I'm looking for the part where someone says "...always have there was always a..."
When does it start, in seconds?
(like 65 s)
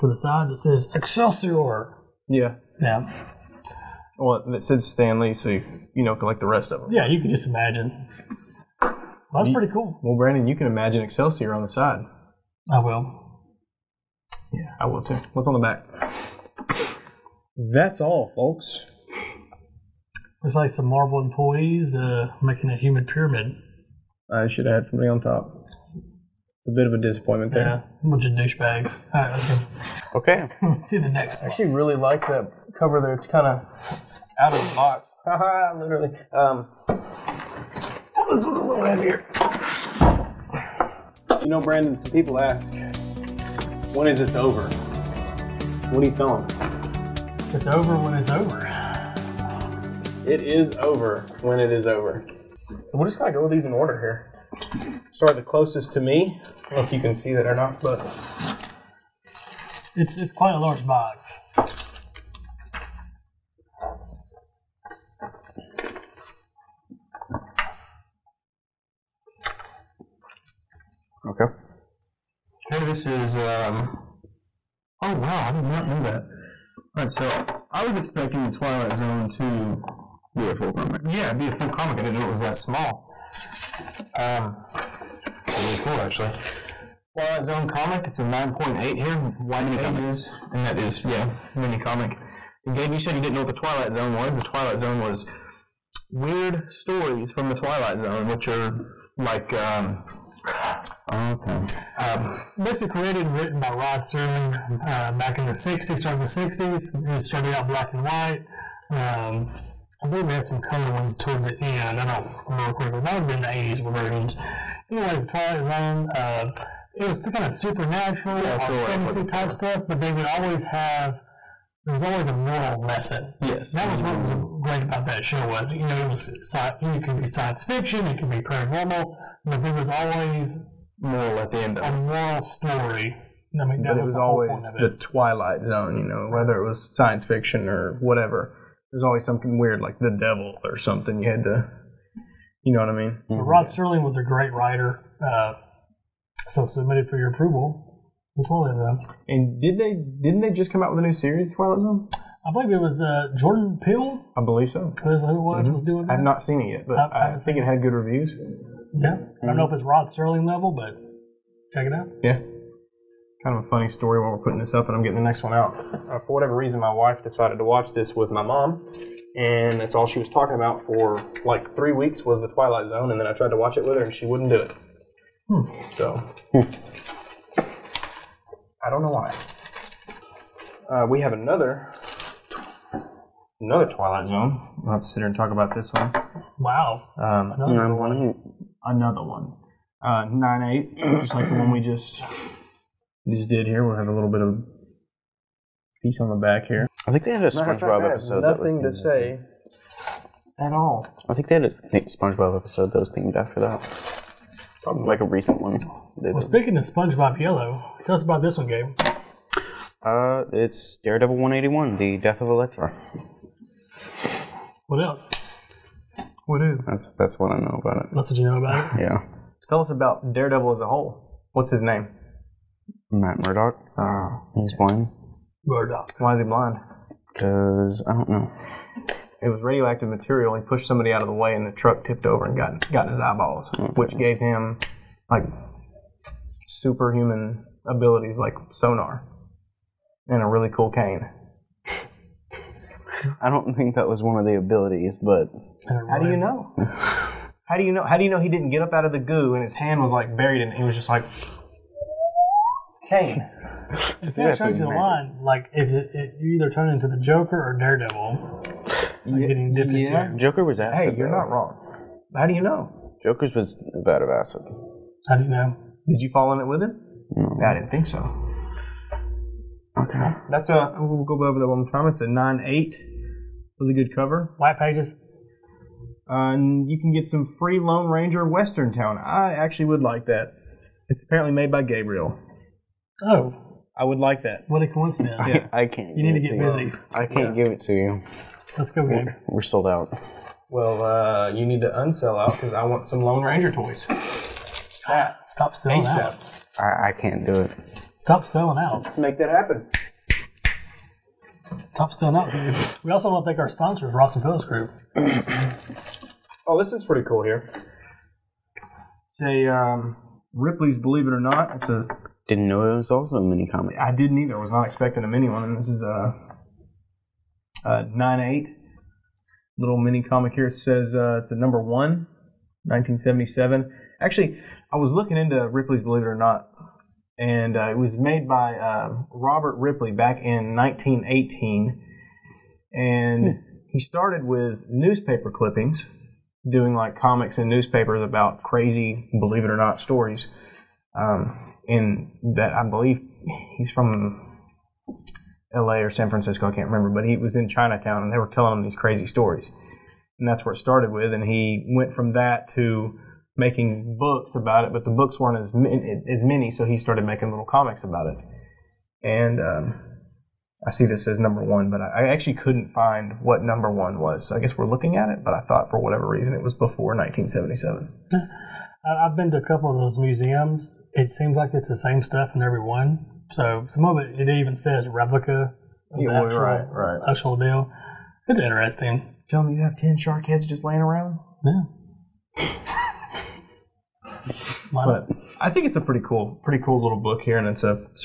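120 s.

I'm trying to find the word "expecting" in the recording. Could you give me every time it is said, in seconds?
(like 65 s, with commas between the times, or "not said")
77 s, 314 s.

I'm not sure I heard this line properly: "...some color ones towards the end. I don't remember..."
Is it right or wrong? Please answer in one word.
right.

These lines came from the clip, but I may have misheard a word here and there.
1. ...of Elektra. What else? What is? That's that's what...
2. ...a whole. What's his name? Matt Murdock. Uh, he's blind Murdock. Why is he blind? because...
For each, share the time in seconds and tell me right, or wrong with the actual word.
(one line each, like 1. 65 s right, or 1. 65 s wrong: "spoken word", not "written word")
1. 212 s right
2. 220 s right.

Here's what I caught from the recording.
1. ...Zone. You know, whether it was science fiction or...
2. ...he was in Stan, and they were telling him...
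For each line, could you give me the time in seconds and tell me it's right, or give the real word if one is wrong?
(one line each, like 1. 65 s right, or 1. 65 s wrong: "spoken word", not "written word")
1. 135 s right
2. 347 s wrong: "Chinatown", not "Stan".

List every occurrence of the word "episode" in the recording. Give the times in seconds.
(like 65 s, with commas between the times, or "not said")
198 s, 202 s.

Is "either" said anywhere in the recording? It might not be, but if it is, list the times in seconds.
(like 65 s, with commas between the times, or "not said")
256 s, 314 s.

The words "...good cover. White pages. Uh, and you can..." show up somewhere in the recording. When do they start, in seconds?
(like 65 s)
273 s.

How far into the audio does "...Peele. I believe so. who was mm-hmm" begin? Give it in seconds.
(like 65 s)
153 s.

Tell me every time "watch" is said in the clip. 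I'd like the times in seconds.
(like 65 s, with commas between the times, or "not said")
167 s, 173 s.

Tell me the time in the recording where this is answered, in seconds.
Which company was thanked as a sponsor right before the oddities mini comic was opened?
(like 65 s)
304 s.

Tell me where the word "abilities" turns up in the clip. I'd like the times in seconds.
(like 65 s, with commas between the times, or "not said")
237 s, 244 s.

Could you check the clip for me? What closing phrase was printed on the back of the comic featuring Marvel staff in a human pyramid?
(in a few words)
That's all, folks.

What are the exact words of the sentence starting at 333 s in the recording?
he started with newspaper clippings, doing like comics and newspapers about crazy Believe It or Not stories.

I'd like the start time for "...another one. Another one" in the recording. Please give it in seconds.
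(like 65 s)
187 s.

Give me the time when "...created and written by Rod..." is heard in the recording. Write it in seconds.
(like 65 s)
102 s.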